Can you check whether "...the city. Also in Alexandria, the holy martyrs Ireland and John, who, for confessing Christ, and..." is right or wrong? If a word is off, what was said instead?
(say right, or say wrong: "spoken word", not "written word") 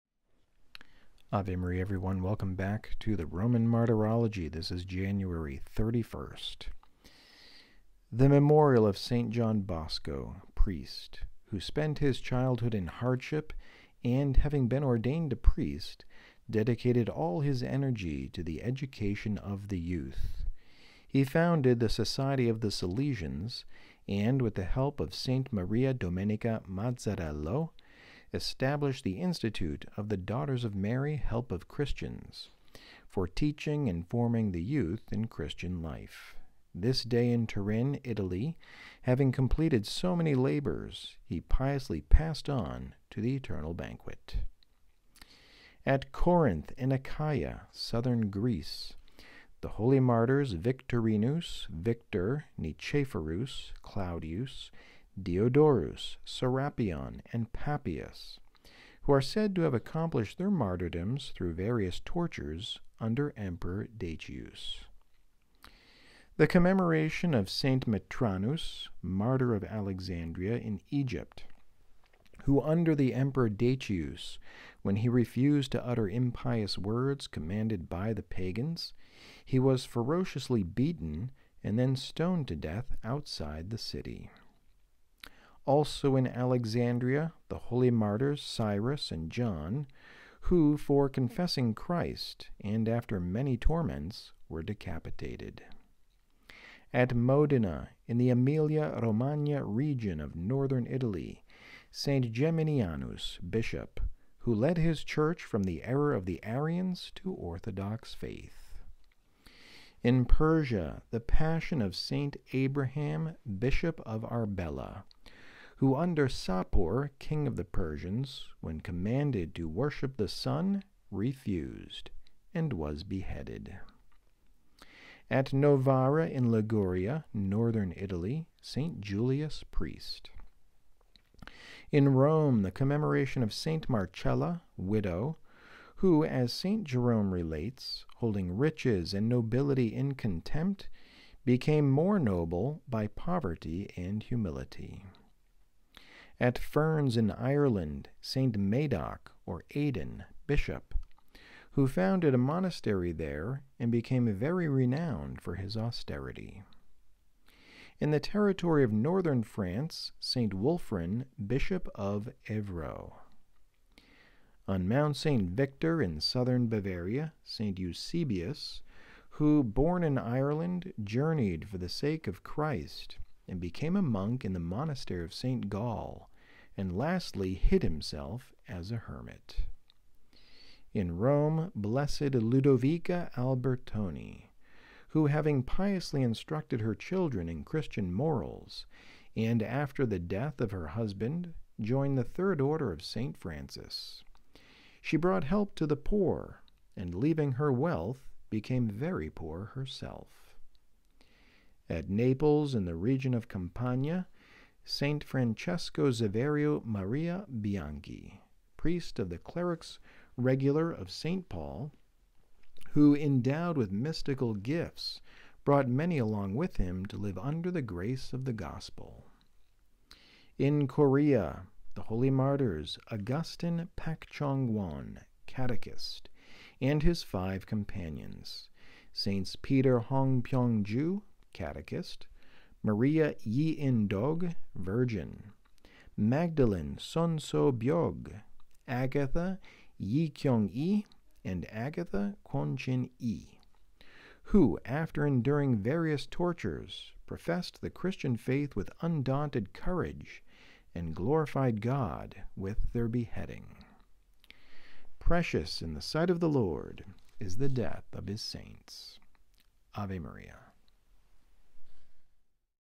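wrong: "Cyrus", not "Ireland".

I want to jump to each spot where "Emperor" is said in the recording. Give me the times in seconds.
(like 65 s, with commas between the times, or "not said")
63 s, 73 s.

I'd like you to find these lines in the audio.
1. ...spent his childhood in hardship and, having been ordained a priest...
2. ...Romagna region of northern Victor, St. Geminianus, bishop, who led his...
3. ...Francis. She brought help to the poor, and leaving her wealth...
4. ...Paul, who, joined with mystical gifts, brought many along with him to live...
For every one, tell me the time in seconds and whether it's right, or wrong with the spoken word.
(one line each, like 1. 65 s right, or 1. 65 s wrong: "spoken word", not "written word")
1. 11 s right
2. 99 s wrong: "Italy", not "Victor"
3. 193 s right
4. 211 s wrong: "endowed", not "joined".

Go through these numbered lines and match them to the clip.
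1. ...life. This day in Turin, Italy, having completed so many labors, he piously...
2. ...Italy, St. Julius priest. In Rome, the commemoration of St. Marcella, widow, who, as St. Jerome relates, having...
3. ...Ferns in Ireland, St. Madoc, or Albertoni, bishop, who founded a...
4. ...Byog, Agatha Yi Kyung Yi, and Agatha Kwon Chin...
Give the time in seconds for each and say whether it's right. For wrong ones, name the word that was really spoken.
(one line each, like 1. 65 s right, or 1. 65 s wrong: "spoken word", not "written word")
1. 35 s right
2. 127 s wrong: "holding", not "having"
3. 146 s wrong: "Aidan", not "Albertoni"
4. 237 s right.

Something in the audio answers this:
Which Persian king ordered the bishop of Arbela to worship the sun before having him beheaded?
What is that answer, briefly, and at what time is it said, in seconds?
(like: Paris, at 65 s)
Sapor, at 116 s.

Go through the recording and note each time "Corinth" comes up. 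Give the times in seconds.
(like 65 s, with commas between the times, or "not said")
46 s.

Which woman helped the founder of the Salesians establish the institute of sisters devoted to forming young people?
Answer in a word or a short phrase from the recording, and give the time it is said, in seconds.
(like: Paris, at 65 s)
Maria Domenica Mazzarello, at 25 s.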